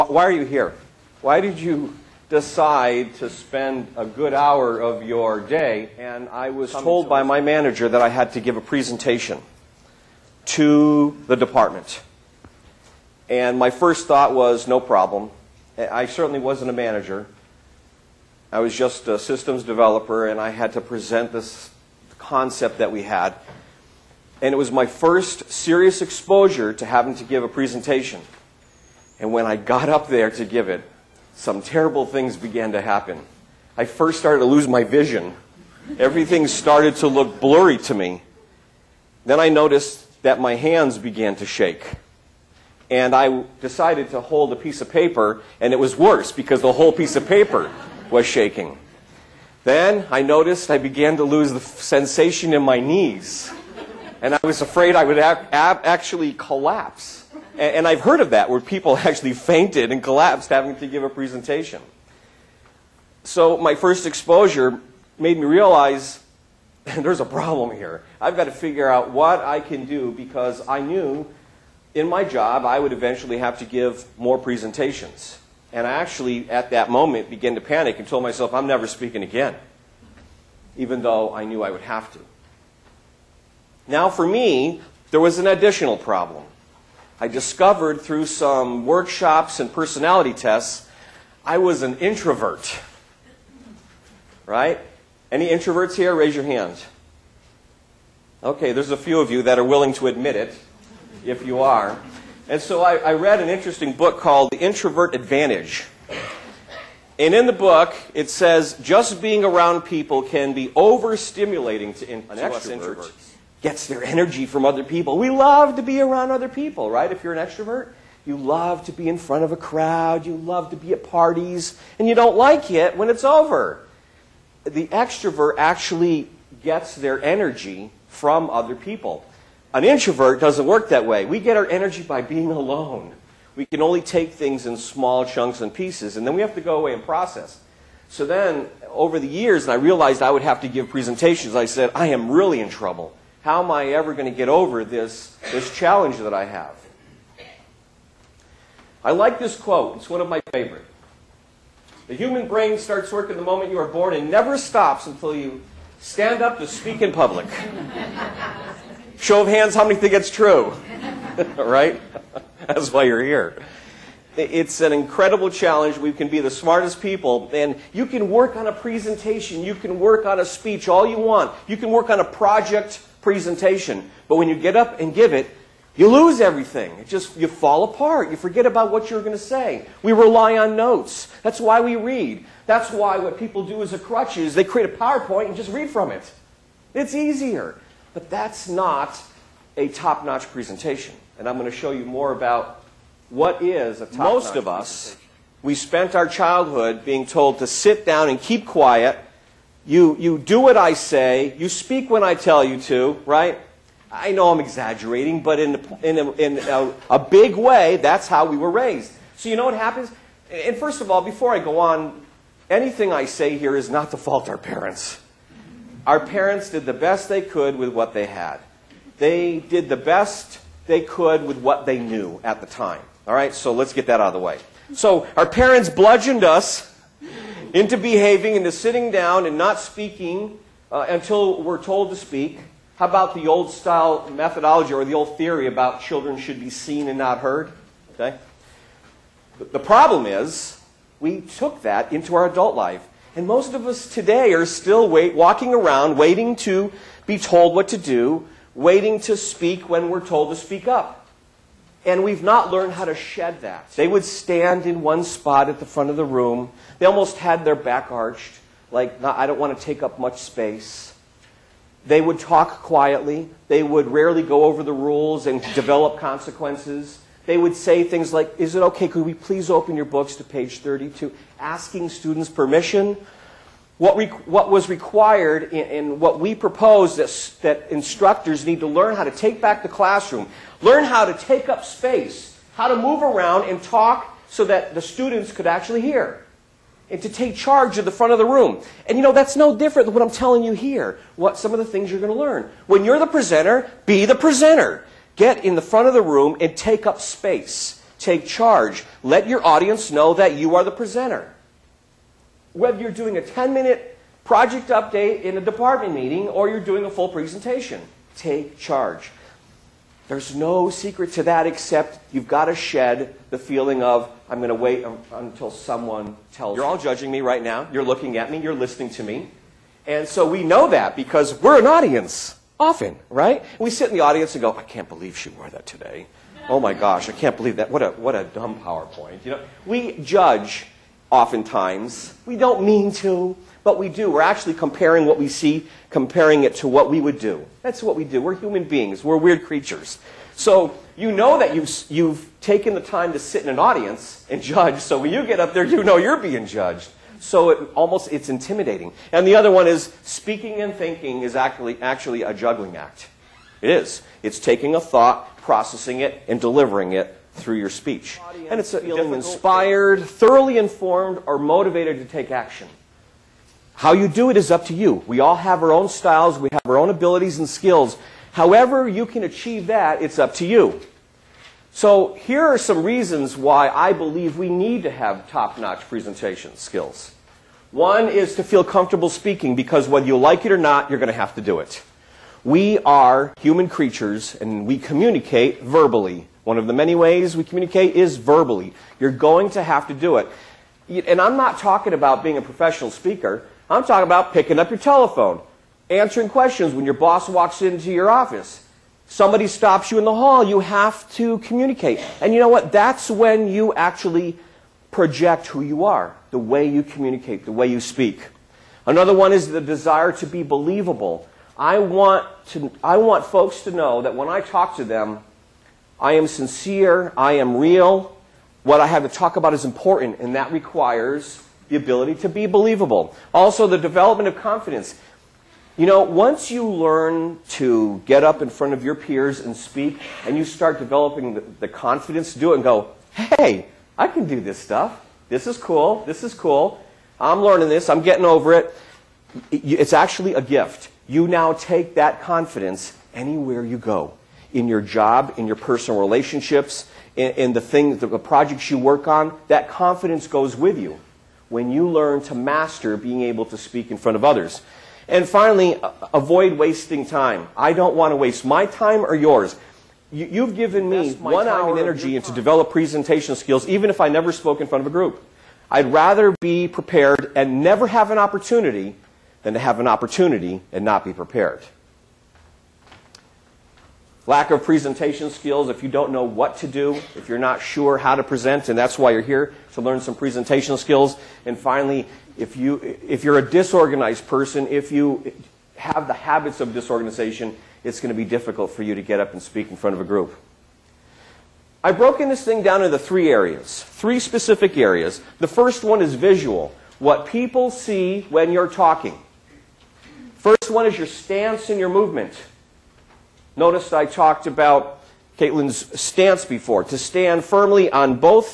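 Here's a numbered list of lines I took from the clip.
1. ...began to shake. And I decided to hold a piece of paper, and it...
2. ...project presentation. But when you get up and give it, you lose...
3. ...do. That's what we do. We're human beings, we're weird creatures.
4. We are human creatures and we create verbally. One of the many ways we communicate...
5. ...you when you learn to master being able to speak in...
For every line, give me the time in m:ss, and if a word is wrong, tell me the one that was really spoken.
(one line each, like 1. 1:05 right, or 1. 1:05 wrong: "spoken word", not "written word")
1. 0:40 right
2. 2:52 right
3. 5:37 right
4. 6:22 wrong: "communicate", not "create"
5. 7:30 right.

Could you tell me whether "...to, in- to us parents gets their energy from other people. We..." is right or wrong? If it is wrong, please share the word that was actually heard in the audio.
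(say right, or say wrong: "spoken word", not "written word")
wrong: "introverts", not "parents".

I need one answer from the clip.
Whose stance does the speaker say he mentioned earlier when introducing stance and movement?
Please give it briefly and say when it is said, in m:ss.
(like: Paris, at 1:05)
Caitlin, at 8:25.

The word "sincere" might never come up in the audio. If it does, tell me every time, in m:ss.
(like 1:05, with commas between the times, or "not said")
6:56.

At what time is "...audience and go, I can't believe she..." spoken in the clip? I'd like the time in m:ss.
5:24.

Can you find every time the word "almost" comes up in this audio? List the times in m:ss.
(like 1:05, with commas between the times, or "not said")
4:17, 5:47.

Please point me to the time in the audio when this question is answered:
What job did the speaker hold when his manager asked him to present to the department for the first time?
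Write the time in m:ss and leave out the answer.
0:19.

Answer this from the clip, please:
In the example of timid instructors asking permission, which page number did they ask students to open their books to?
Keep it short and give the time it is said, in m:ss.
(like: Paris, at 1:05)
32, at 4:30.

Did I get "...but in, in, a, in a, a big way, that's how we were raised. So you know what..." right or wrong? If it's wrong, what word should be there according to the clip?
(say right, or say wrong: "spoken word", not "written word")
right.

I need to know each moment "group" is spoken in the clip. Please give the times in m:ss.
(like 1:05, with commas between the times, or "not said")
7:45, 8:10.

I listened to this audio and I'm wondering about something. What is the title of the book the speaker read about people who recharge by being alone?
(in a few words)
The Introvert Advantage.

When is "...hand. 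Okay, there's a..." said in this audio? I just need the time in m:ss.
1:36.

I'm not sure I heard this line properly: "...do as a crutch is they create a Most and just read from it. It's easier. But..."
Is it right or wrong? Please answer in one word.
wrong.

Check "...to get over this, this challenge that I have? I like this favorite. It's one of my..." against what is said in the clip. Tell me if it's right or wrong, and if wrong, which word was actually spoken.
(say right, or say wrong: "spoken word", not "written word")
wrong: "quote", not "favorite".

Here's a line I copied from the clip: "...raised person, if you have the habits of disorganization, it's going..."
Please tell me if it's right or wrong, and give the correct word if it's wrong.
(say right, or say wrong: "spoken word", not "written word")
wrong: "disorganized", not "raised".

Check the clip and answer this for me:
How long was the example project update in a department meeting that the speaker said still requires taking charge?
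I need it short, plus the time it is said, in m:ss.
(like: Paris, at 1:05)
10 minute, at 5:03.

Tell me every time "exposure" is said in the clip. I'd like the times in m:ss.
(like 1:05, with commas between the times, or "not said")
0:26, 1:04.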